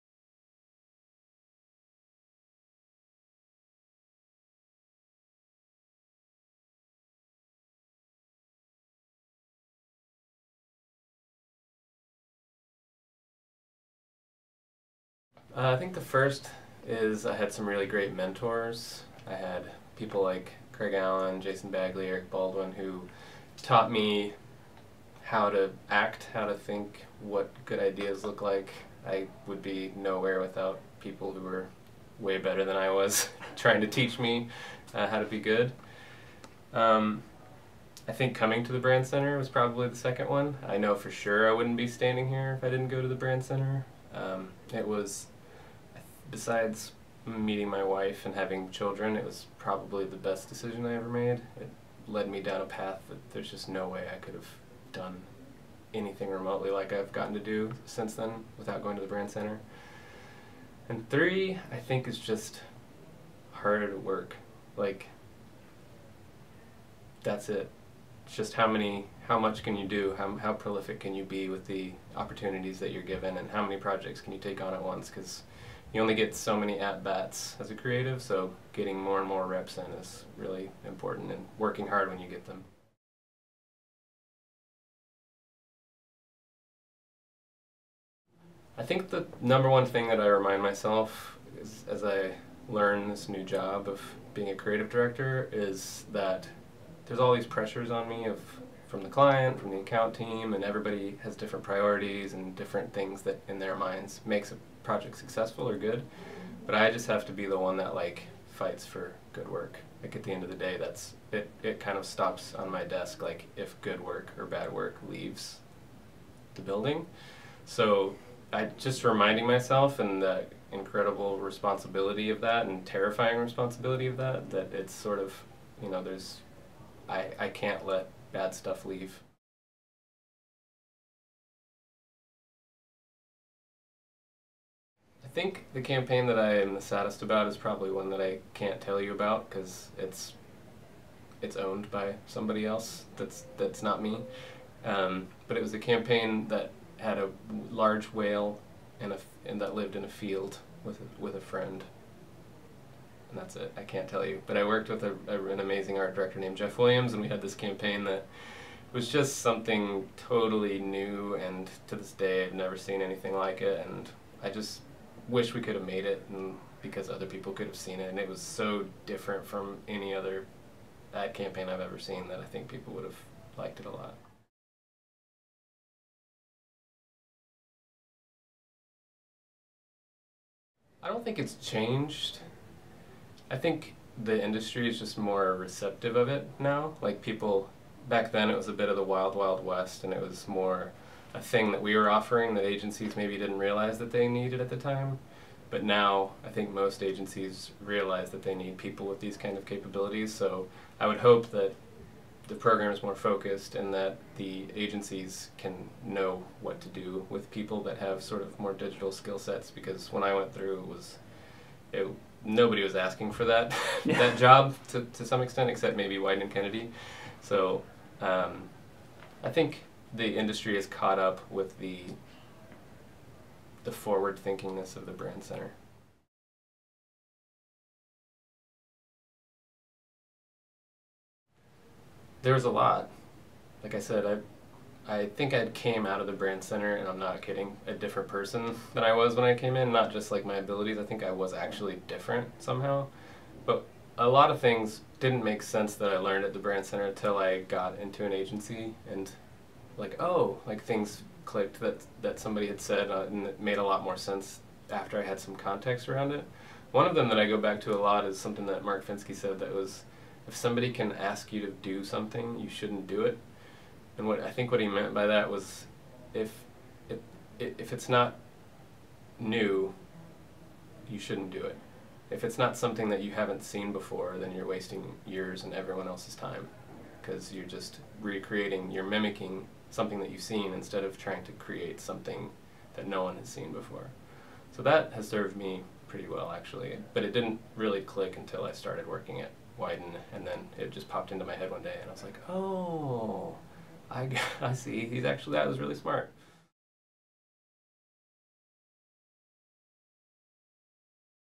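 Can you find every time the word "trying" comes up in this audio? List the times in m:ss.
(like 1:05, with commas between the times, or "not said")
0:33, 4:41.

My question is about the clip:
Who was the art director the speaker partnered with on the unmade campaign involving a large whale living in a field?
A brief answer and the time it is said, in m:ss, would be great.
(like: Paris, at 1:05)
Jeff Williams, at 2:36.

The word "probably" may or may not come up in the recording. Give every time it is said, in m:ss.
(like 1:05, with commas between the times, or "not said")
0:39, 0:49, 2:17.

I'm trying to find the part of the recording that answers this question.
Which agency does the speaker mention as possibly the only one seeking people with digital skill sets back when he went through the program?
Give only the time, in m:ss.
3:36.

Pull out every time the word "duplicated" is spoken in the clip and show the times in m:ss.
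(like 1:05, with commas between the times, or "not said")
not said.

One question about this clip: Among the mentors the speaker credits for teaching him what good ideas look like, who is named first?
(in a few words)
Craig Allen.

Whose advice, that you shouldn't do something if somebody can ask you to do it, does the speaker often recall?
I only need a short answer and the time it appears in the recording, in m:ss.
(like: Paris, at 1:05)
Mark Fenske, at 4:18.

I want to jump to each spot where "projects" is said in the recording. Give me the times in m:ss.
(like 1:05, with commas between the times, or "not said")
1:13, 1:44.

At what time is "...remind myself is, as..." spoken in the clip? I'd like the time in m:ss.
1:30.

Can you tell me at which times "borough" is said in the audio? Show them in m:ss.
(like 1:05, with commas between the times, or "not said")
not said.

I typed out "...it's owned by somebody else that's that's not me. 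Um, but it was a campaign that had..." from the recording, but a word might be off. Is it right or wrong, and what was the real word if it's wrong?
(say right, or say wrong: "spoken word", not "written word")
right.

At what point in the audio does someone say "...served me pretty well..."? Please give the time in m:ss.
4:45.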